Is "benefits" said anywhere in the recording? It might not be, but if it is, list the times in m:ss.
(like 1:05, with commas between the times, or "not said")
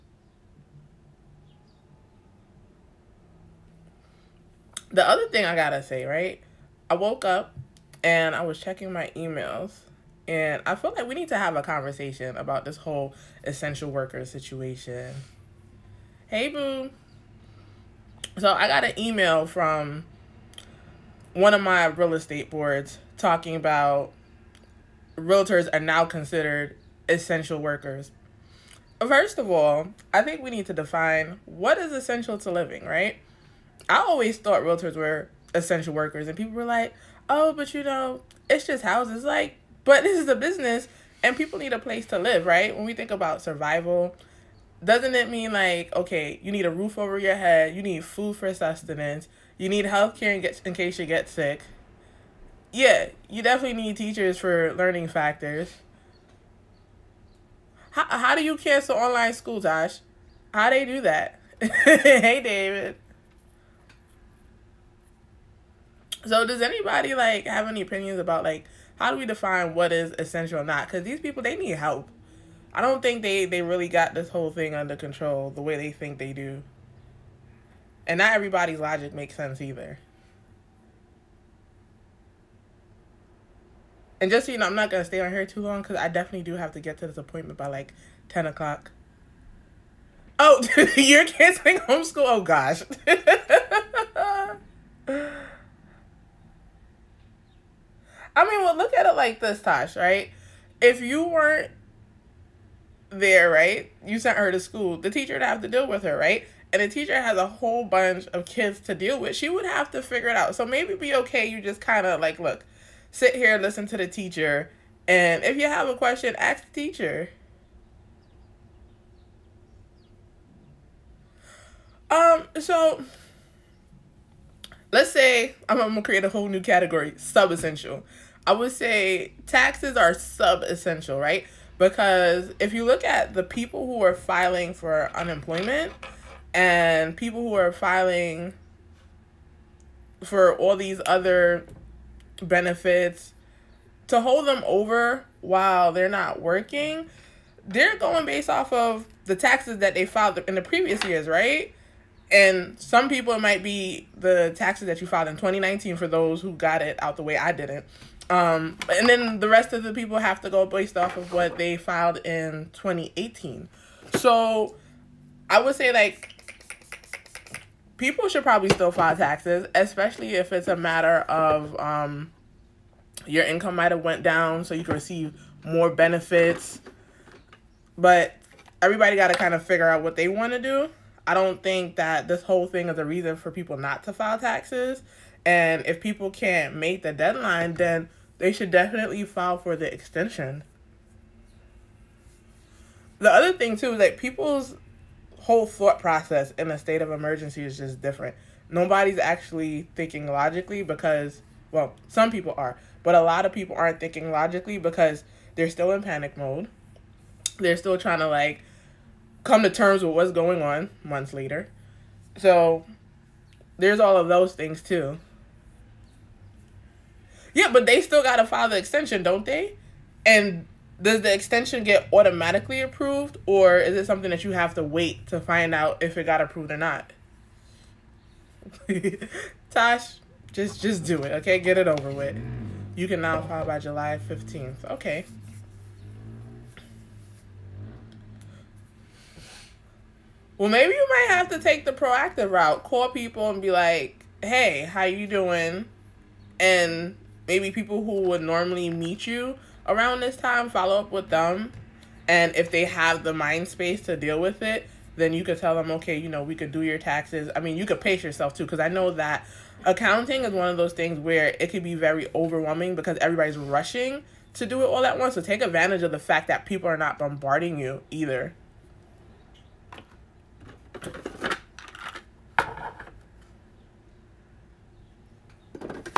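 2:22, 2:55.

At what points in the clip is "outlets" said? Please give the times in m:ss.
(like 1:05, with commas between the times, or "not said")
not said.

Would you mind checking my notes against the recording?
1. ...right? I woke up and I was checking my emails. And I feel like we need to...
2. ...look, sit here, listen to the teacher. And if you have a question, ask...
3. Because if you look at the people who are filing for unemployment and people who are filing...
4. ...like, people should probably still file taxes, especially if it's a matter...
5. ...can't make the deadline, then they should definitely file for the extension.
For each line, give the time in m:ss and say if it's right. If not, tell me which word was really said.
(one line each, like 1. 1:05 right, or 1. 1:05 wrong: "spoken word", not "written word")
1. 0:06 right
2. 1:52 right
3. 2:11 right
4. 2:45 right
5. 3:06 right.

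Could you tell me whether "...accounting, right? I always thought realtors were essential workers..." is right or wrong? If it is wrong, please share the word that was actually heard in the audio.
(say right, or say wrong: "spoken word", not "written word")
wrong: "living", not "accounting".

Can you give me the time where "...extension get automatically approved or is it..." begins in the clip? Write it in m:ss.
3:41.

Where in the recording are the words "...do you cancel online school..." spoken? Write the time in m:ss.
0:58.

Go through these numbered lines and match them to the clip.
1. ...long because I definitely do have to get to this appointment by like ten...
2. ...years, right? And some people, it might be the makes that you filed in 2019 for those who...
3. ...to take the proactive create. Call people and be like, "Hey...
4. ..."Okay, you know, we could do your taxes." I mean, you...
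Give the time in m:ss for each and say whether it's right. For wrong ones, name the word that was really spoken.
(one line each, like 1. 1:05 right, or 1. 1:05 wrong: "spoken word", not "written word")
1. 1:25 right
2. 2:31 wrong: "taxes", not "makes"
3. 4:01 wrong: "route", not "create"
4. 4:15 right.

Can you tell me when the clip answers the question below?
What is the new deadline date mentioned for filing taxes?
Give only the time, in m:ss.
3:53.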